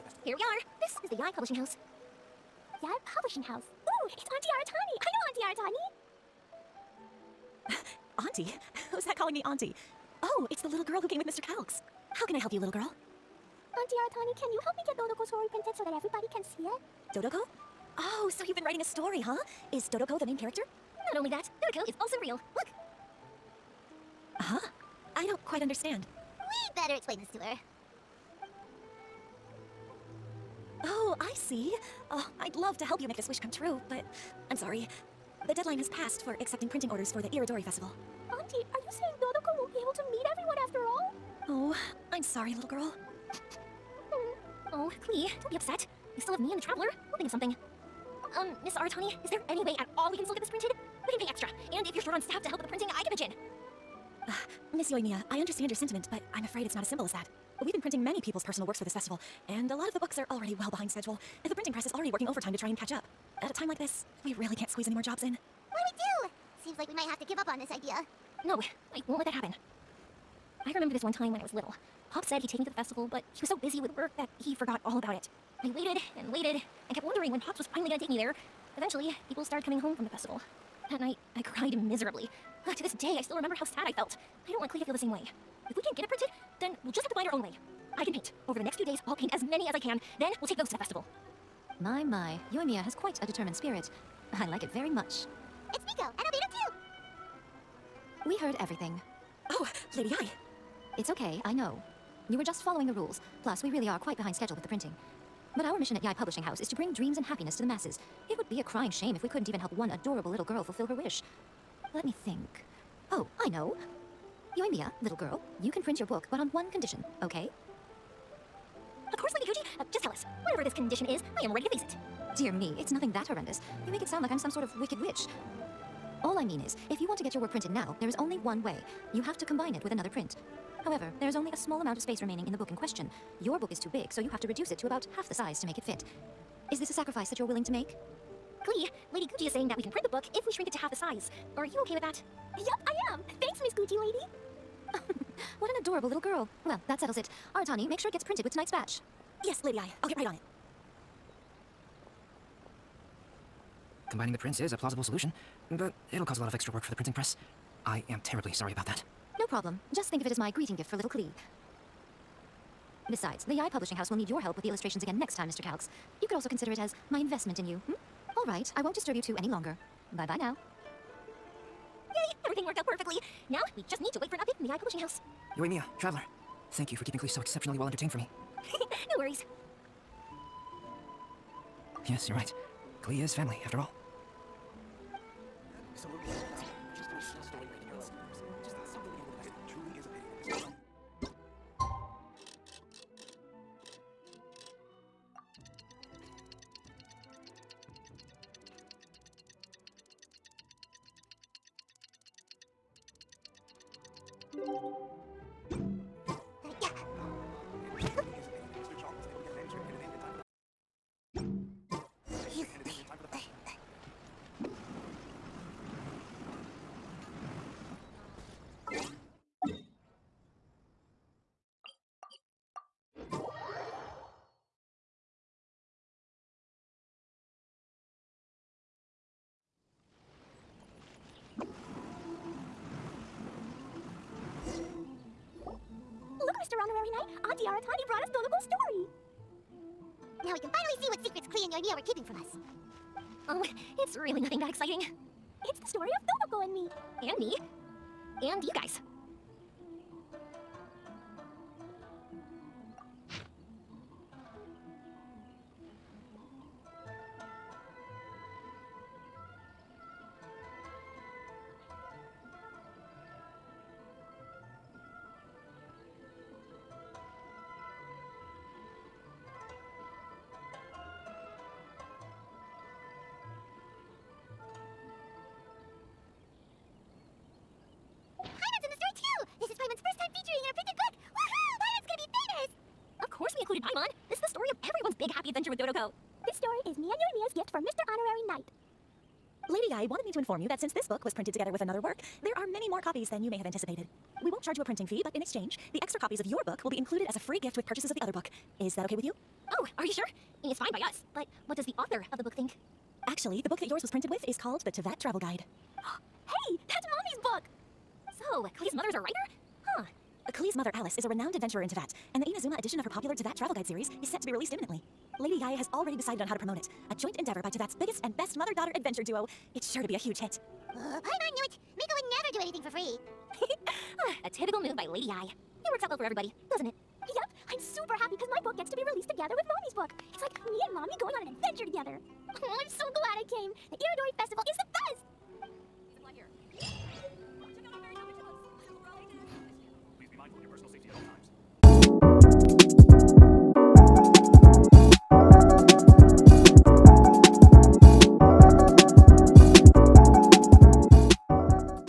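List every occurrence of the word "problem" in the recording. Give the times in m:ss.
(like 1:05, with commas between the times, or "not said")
2:39.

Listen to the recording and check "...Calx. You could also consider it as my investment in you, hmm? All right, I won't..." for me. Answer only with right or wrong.
right.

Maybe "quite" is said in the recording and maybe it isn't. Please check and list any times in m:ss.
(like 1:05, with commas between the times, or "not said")
0:25, 1:32, 1:43.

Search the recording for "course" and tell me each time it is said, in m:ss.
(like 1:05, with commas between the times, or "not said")
1:59, 4:43.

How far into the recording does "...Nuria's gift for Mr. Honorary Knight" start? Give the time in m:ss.
4:47.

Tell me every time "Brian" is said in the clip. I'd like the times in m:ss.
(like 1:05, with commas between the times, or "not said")
not said.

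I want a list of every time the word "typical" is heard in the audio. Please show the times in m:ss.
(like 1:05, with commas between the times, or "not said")
5:24.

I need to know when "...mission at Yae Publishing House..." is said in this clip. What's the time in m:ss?
1:45.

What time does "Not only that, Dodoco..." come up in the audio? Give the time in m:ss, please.
0:21.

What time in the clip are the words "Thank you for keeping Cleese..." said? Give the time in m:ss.
2:56.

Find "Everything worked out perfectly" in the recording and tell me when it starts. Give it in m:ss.
2:52.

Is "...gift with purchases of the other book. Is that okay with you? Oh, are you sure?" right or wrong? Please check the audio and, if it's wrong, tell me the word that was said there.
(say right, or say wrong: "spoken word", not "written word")
right.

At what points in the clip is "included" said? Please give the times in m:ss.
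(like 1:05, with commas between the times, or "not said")
4:43, 4:56.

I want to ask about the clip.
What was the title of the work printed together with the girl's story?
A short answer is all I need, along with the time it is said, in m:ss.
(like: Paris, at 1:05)
The Teyvat Travel Guide, at 5:04.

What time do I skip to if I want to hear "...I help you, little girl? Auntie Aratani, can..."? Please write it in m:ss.
0:12.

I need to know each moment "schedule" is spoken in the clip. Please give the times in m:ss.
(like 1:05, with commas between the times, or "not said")
1:00, 1:44.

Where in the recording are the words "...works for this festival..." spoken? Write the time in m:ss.
0:58.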